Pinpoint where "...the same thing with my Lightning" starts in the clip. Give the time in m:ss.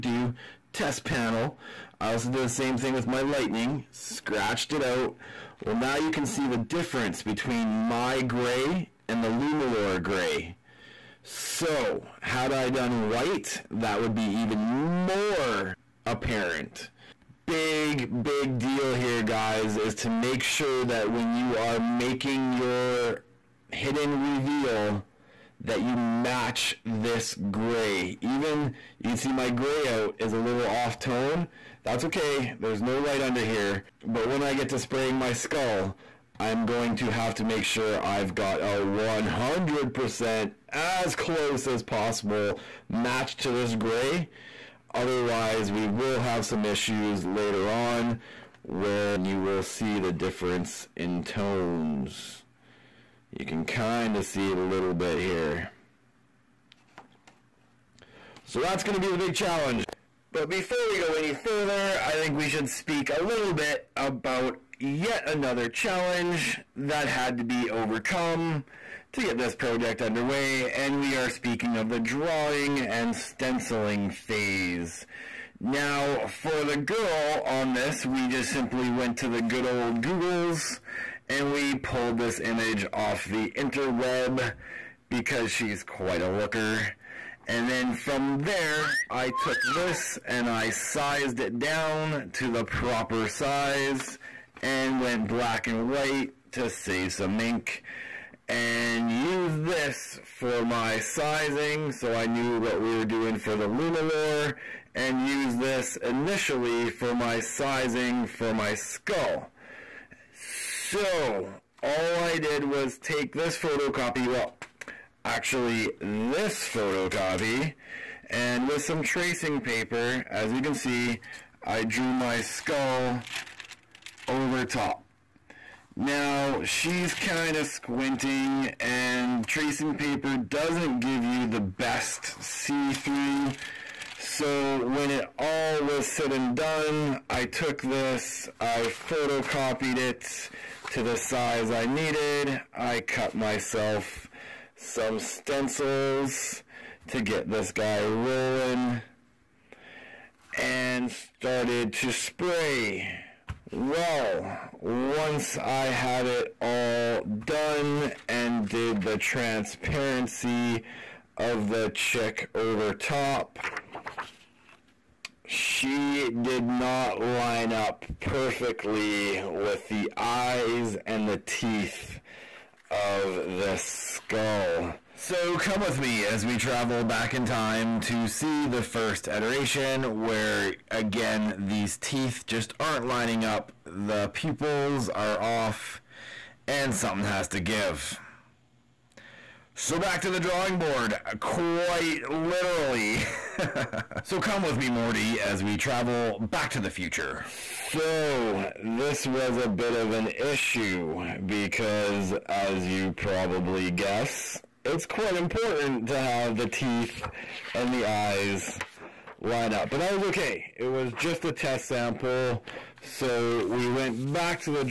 0:02.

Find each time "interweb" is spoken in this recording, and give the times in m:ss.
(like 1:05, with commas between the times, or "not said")
1:23.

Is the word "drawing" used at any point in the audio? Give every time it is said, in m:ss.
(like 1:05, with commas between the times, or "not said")
1:11, 3:10.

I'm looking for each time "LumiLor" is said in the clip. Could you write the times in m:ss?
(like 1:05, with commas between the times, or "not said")
0:09, 1:43.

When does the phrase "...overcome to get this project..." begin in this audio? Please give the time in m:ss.
1:07.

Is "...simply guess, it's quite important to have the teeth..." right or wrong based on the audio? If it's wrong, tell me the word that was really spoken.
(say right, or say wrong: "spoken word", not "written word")
wrong: "probably", not "simply".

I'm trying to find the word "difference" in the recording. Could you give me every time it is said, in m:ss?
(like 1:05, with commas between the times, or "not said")
0:06, 0:50.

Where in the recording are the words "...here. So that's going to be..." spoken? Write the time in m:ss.
0:55.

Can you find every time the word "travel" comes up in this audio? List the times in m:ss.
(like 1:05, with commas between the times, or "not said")
2:56, 3:15.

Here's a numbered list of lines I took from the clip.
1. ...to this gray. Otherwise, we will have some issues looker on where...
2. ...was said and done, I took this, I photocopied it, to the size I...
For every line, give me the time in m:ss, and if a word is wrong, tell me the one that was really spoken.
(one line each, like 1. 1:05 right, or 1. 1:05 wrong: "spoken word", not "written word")
1. 0:43 wrong: "later", not "looker"
2. 2:15 right.